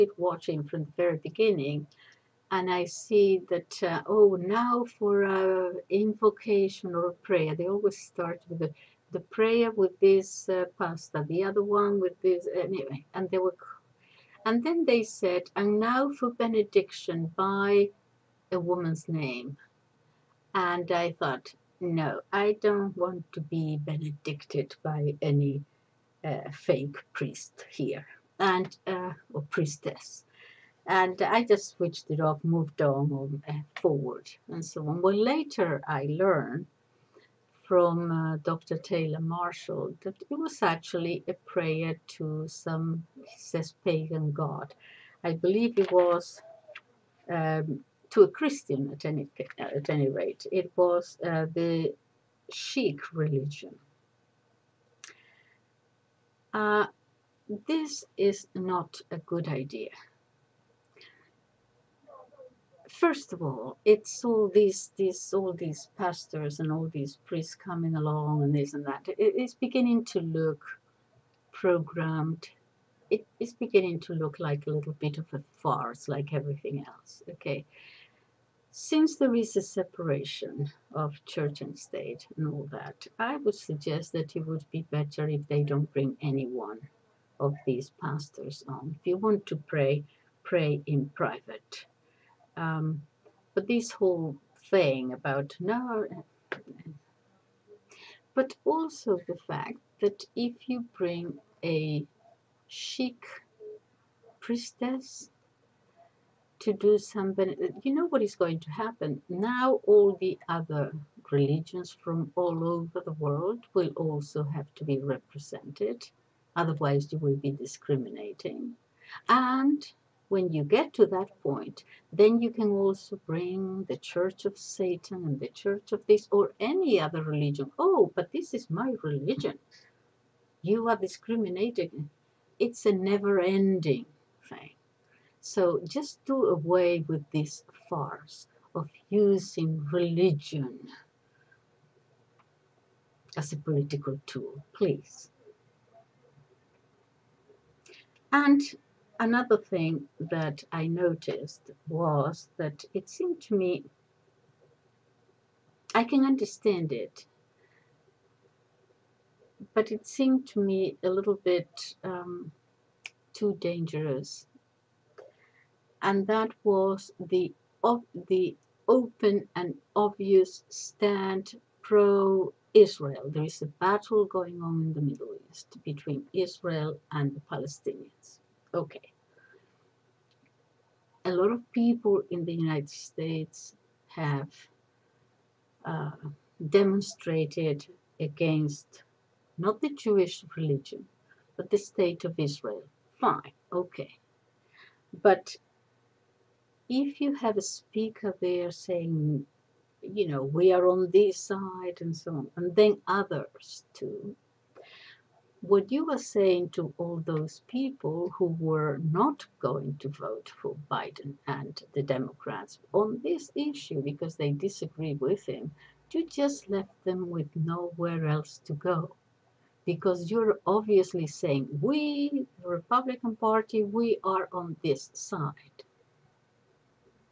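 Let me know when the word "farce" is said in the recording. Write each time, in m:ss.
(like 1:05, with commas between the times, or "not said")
1:15, 2:17.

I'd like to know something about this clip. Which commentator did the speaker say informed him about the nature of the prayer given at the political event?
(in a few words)
Dr. Taylor Marshall.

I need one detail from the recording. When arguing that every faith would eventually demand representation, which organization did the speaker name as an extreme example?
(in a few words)
Church of Satan.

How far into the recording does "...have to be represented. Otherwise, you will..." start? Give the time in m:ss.
1:54.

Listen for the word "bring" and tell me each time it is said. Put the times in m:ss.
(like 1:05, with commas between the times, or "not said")
1:25, 1:40, 2:03.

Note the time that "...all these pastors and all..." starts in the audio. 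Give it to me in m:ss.
1:05.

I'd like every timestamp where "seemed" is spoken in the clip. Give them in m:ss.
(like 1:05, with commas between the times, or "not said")
2:33, 2:40.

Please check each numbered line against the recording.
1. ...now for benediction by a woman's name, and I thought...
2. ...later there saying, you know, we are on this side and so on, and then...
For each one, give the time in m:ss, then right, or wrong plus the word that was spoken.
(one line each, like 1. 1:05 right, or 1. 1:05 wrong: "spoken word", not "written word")
1. 0:15 right
2. 3:17 wrong: "speaker", not "later".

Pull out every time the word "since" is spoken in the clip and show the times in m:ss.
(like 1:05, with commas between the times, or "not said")
1:18.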